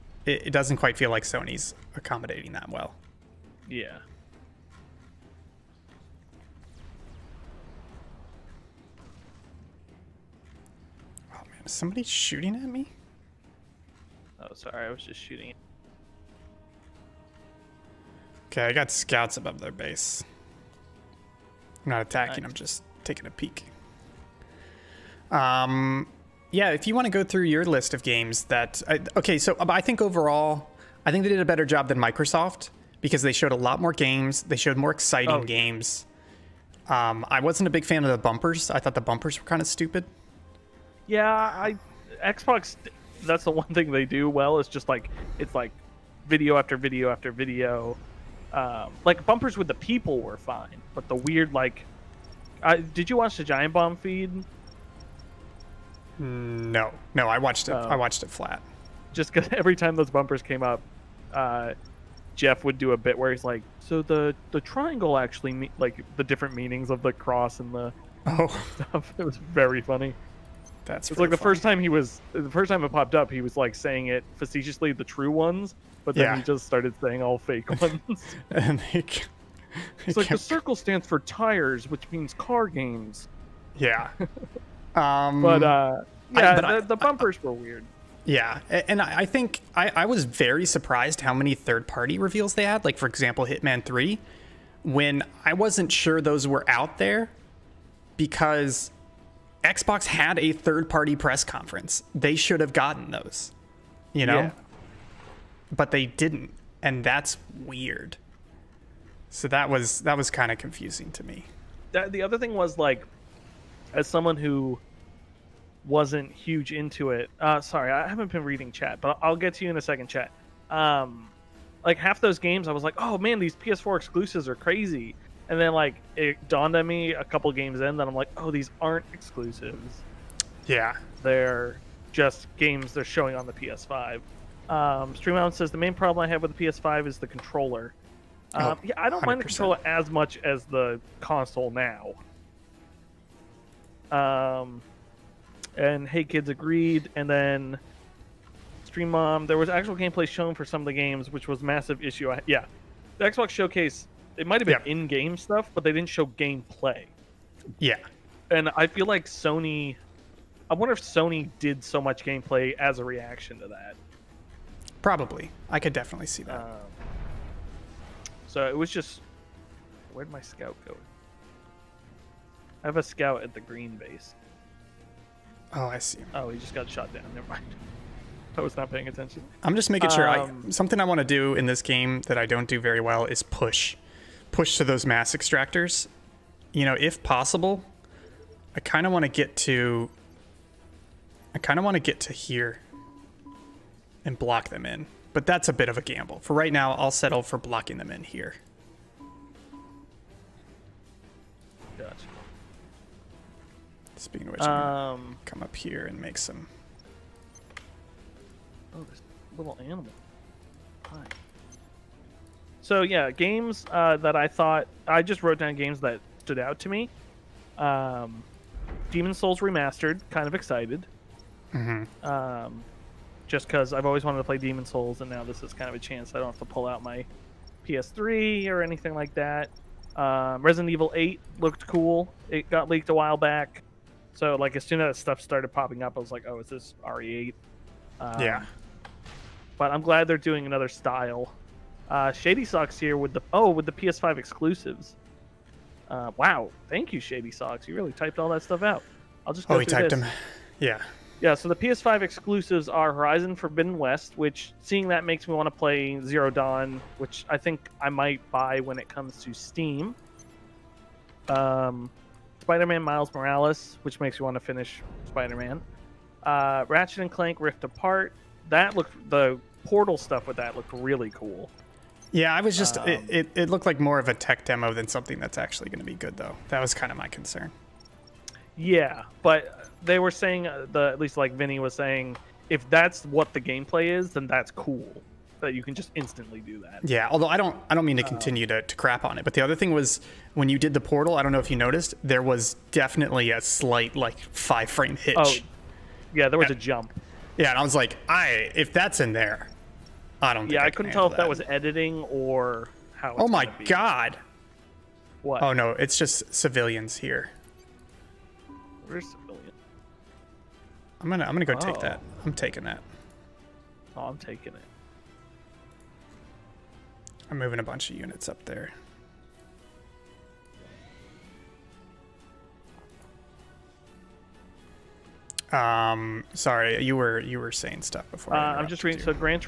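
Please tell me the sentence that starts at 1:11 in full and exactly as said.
first time he was the first time it popped up, he was like saying it facetiously, the true ones, but then yeah.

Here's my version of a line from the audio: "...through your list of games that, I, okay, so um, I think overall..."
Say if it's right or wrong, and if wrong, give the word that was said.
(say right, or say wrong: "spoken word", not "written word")
right.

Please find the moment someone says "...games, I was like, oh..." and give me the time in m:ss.
2:02.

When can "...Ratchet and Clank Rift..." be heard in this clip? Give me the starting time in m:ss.
4:26.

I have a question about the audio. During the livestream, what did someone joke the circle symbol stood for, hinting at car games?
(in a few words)
Tires.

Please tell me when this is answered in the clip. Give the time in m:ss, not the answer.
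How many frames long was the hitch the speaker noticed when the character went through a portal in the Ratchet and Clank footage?
4:54.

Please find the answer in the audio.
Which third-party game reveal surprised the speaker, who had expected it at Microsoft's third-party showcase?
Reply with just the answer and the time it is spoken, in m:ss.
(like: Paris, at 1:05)
Hitman Three, at 1:33.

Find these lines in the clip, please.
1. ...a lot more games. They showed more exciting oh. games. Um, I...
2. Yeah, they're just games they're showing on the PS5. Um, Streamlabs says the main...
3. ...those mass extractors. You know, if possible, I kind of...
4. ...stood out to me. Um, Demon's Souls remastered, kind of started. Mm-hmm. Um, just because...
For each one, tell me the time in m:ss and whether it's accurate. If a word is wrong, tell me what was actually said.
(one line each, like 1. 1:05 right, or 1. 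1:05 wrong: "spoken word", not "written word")
1. 0:33 right
2. 2:10 right
3. 3:04 right
4. 3:36 wrong: "excited", not "started".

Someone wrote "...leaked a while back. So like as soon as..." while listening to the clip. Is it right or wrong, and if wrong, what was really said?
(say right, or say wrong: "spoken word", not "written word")
right.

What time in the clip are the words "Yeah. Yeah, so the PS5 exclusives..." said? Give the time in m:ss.
4:10.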